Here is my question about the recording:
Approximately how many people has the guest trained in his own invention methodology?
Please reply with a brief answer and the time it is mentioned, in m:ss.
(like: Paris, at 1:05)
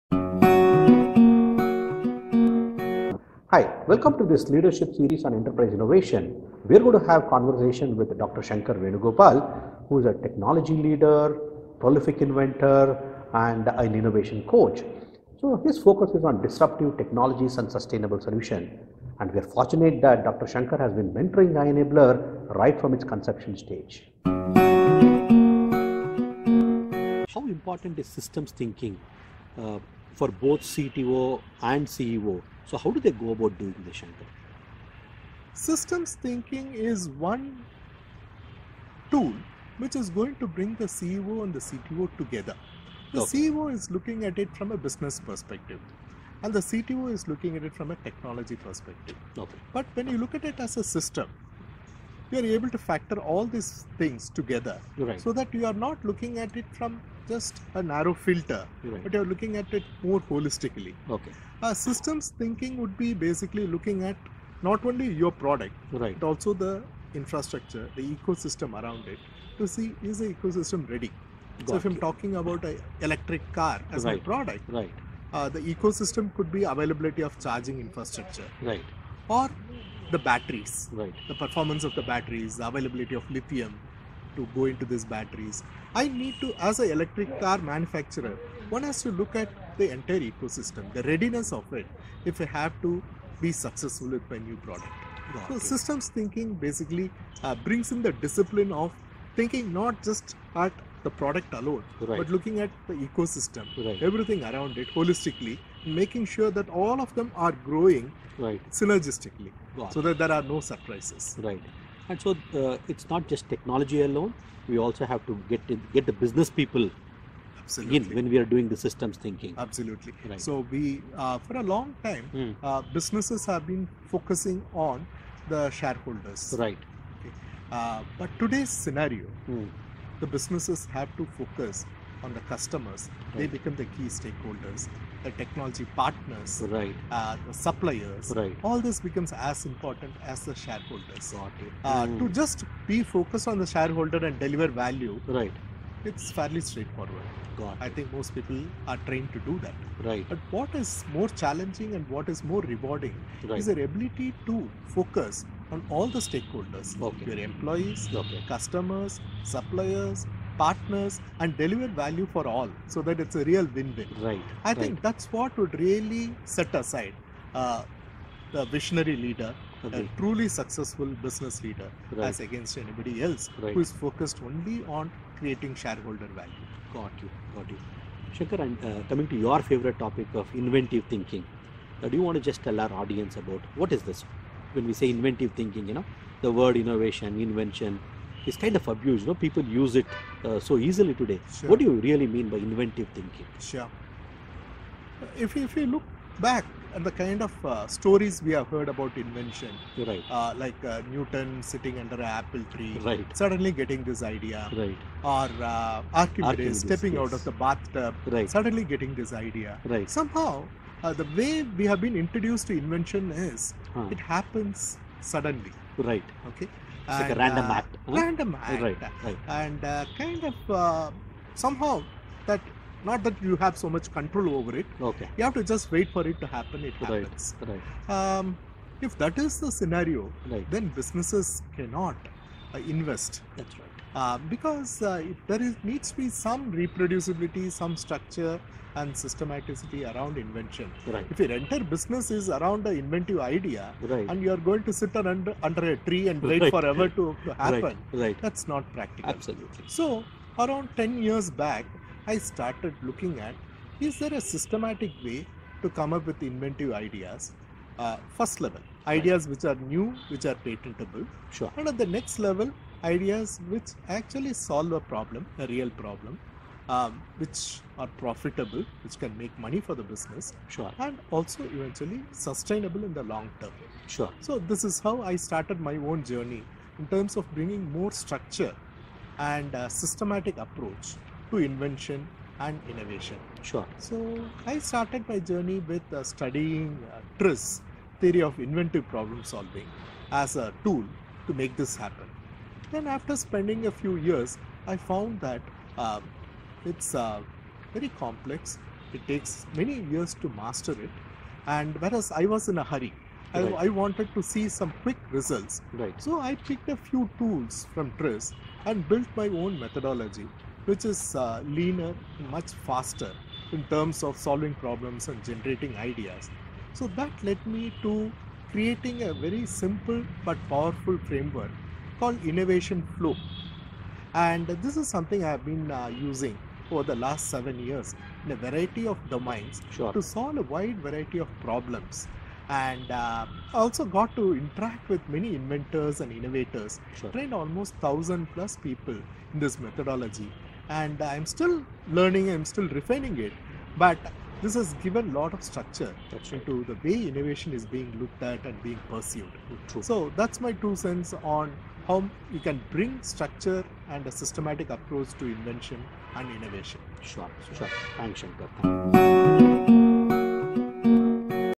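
1000 plus, at 5:37.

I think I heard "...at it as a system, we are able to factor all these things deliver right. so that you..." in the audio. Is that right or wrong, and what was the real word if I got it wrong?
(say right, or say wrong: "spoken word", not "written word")
wrong: "together", not "deliver".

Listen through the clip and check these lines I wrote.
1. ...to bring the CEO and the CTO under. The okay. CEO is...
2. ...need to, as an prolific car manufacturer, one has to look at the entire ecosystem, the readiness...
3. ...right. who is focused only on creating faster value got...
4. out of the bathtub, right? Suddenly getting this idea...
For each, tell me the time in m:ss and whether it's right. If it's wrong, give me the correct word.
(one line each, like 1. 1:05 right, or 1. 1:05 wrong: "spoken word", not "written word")
1. 0:40 wrong: "together", not "under"
2. 1:26 wrong: "electric", not "prolific"
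3. 2:53 wrong: "shareholder", not "faster"
4. 3:27 right.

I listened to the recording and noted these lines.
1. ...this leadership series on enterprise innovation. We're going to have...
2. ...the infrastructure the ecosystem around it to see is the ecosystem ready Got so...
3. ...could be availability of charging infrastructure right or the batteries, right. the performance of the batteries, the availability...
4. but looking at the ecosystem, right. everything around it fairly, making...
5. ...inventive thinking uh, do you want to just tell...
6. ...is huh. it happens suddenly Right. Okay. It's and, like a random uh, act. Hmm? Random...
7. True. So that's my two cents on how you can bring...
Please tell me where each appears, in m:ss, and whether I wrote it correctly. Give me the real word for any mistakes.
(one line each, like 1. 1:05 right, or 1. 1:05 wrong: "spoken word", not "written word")
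1. 0:04 right
2. 1:06 right
3. 1:16 right
4. 1:42 wrong: "holistically", not "fairly"
5. 3:00 right
6. 3:33 right
7. 5:49 right.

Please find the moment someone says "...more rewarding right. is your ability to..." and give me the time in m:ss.
2:32.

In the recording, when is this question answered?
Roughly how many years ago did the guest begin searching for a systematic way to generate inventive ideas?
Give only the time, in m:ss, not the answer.
4:10.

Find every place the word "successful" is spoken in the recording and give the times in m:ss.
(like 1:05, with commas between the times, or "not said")
1:33, 2:50.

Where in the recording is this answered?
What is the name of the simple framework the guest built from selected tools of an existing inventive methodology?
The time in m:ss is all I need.
5:22.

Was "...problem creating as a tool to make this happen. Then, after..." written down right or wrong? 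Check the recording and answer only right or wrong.
wrong.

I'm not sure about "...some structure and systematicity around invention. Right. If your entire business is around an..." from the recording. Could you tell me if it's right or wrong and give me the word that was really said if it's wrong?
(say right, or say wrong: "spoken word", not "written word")
right.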